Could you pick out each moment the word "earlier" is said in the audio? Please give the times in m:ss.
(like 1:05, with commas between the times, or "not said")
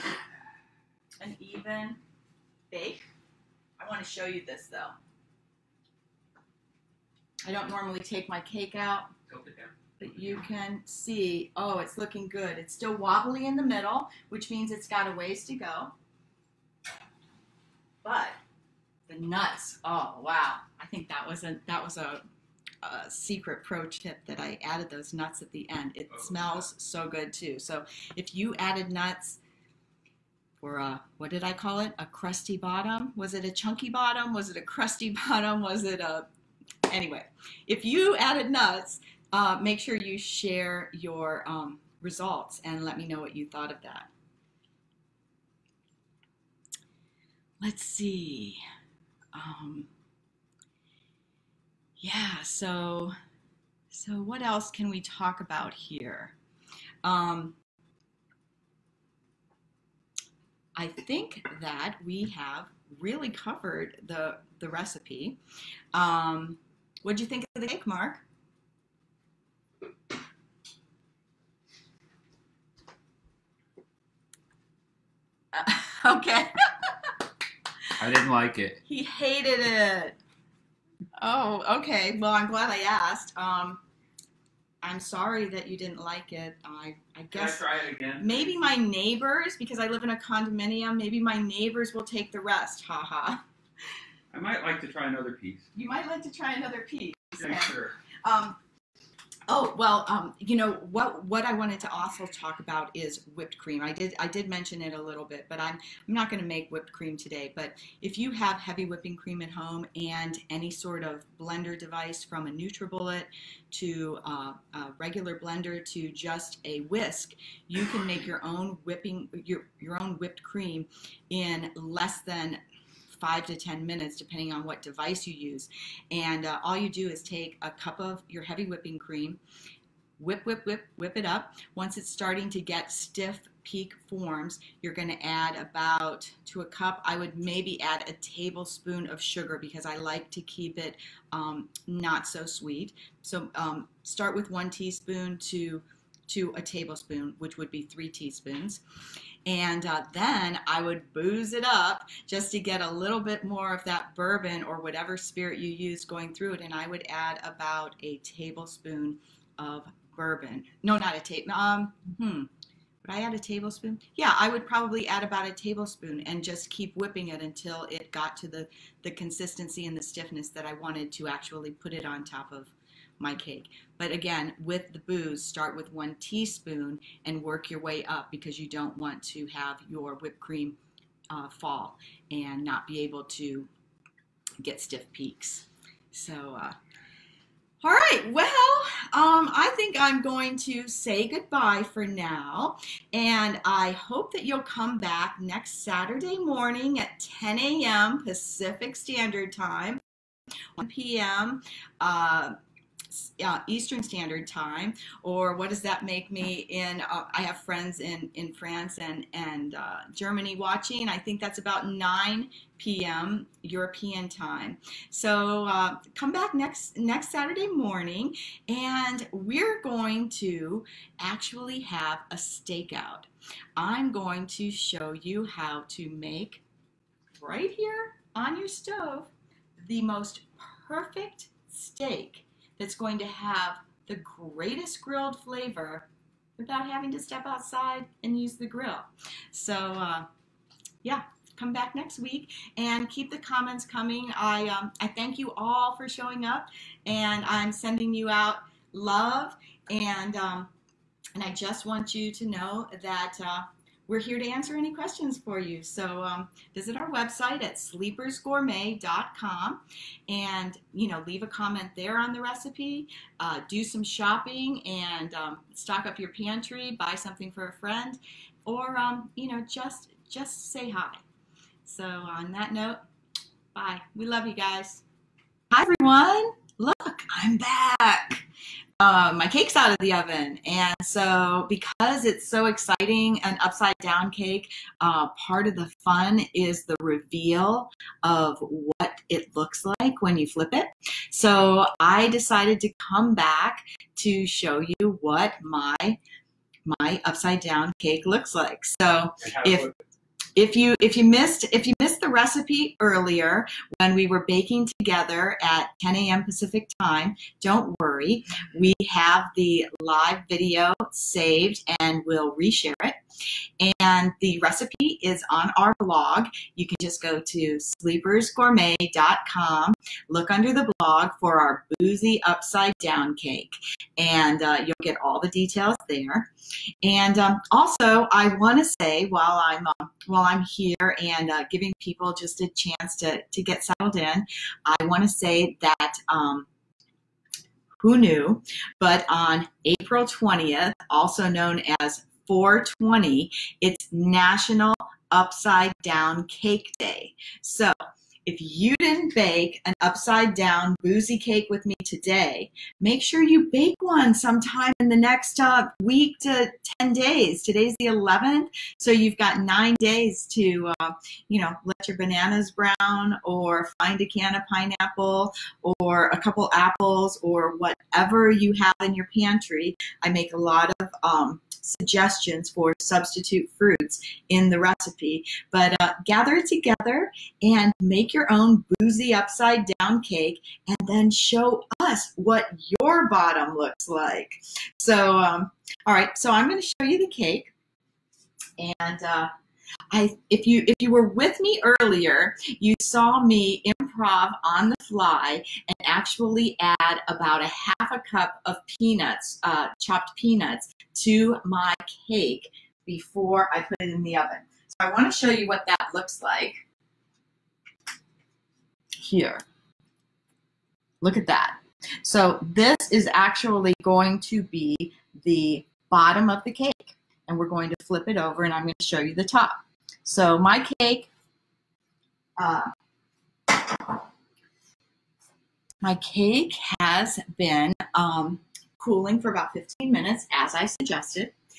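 5:02, 6:31.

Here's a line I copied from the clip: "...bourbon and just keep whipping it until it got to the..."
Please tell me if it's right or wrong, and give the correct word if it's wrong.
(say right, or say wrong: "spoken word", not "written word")
wrong: "tablespoon", not "bourbon".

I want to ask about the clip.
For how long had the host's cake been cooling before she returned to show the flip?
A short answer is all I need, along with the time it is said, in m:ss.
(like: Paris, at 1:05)
15 minutes, at 7:09.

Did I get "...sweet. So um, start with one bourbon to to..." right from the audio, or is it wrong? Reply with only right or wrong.
wrong.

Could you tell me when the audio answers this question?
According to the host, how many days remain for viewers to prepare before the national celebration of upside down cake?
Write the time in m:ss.
5:59.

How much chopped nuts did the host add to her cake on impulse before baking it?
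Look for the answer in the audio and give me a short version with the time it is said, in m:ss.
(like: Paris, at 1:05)
half a cup, at 6:37.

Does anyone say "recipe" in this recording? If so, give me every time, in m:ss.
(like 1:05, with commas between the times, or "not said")
1:04, 4:22, 5:02, 5:14, 6:14.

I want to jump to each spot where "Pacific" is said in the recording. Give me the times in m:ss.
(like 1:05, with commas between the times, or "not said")
3:18, 5:06.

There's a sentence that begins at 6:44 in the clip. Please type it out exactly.
So I want to show you what that looks like here.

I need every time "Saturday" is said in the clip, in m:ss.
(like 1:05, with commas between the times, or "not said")
3:15, 3:37.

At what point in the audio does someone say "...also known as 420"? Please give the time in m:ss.
5:41.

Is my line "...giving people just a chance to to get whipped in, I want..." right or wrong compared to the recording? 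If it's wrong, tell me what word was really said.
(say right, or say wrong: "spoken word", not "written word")
wrong: "settled", not "whipped".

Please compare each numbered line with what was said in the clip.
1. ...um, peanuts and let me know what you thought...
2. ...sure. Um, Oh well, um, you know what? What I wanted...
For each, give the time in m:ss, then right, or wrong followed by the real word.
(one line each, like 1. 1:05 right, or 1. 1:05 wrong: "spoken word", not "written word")
1. 0:41 wrong: "results", not "peanuts"
2. 1:37 right.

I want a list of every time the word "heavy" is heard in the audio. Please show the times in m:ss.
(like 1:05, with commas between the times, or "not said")
1:48, 2:08.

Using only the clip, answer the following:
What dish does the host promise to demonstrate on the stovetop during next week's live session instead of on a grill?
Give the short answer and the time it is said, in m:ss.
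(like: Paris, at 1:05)
steak, at 3:51.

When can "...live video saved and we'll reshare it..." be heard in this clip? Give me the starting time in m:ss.
5:10.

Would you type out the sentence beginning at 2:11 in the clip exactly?
Once it's starting to get stiff peak forms, you're going to add about to a cup.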